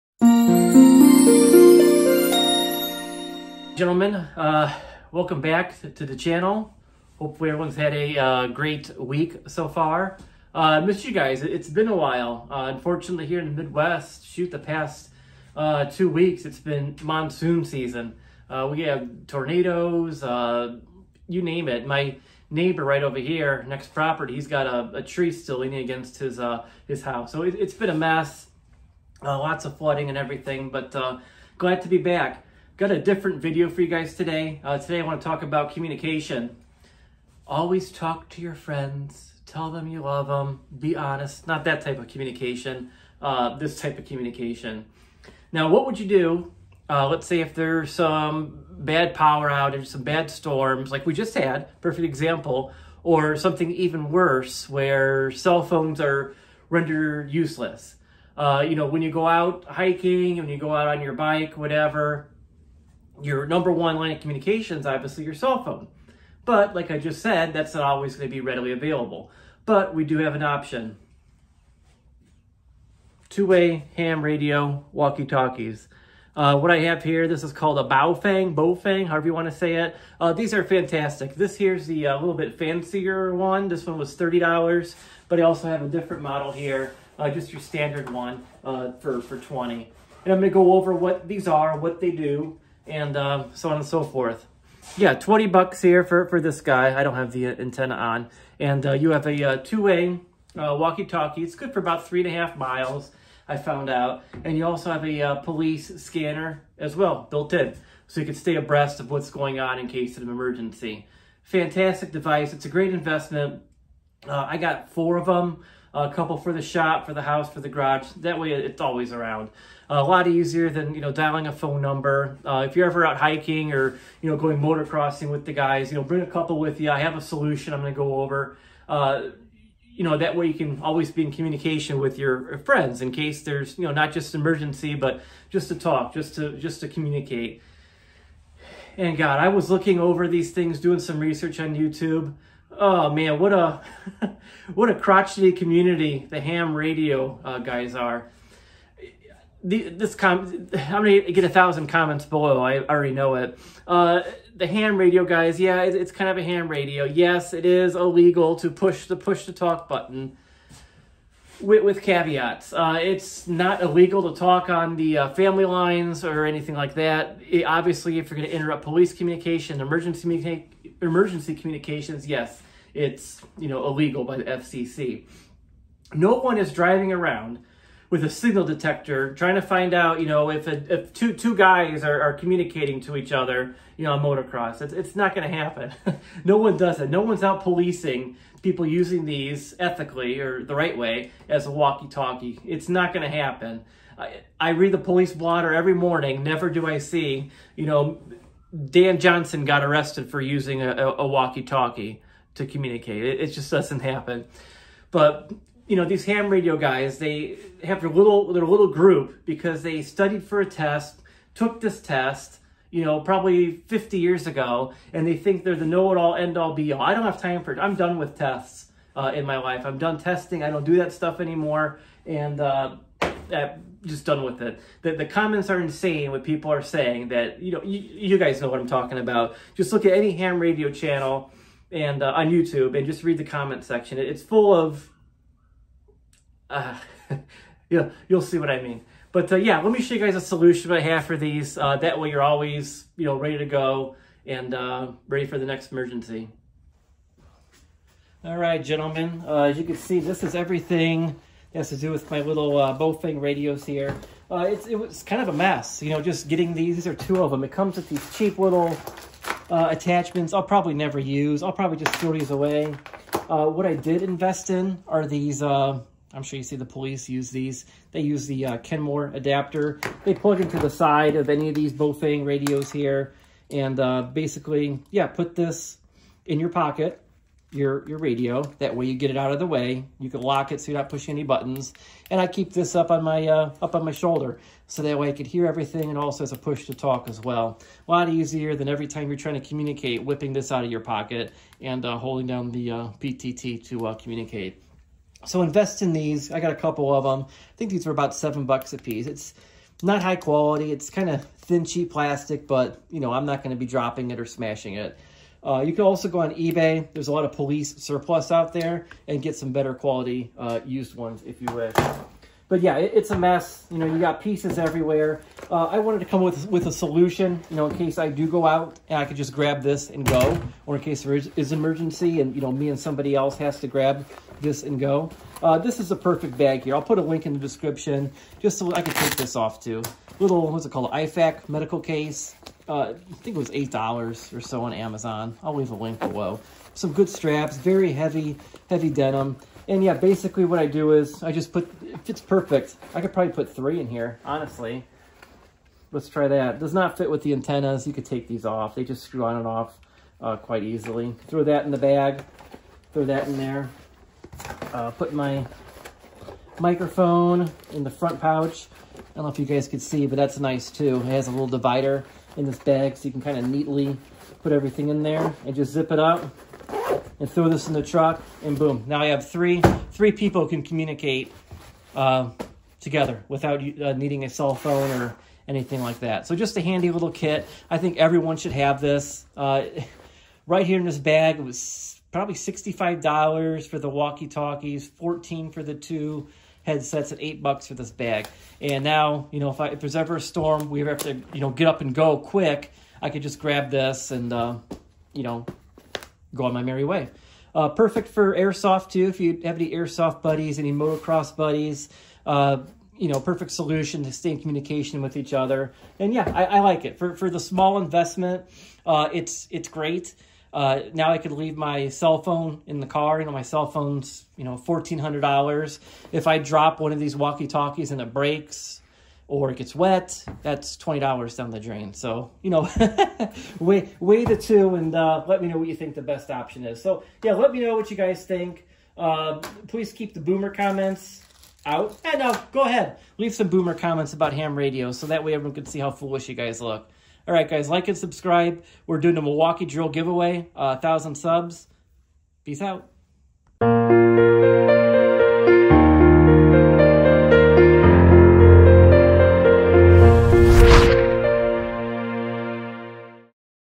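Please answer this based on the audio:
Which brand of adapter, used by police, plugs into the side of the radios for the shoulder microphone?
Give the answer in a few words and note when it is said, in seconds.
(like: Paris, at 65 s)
Kenwood, at 268 s.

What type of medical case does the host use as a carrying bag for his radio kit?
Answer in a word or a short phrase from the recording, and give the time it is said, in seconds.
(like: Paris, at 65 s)
IFAK medical case, at 331 s.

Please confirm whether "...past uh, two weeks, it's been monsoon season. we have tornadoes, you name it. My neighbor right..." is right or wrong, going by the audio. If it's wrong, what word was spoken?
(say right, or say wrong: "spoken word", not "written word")
right.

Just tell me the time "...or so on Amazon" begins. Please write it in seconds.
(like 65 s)
334 s.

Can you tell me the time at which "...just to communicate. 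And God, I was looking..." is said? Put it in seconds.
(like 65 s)
136 s.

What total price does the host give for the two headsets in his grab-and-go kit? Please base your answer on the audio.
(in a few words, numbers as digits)
14.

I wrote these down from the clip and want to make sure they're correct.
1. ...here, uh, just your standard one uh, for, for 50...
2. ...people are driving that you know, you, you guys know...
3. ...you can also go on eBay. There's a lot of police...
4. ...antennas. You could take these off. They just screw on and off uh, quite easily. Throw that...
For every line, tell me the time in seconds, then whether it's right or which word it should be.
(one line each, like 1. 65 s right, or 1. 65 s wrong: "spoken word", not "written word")
1. 86 s wrong: "20", not "50"
2. 226 s wrong: "saying", not "driving"
3. 305 s right
4. 347 s right.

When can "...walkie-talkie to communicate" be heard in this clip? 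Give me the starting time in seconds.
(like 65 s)
201 s.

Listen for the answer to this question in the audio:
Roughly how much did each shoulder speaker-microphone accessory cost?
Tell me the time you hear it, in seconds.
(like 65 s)
298 s.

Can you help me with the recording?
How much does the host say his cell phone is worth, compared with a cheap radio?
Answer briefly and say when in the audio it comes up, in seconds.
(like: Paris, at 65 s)
$1,400, at 414 s.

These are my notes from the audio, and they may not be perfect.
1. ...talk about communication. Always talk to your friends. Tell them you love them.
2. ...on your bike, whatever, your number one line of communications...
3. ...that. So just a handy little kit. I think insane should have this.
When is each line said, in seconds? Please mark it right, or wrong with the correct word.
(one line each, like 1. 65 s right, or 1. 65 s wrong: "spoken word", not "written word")
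1. 35 s right
2. 60 s right
3. 376 s wrong: "everyone", not "insane".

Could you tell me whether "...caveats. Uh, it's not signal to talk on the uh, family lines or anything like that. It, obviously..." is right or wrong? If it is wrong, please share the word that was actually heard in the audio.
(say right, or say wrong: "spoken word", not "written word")
wrong: "illegal", not "signal".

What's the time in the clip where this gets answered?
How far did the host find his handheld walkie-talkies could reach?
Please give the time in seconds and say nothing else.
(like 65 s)
102 s.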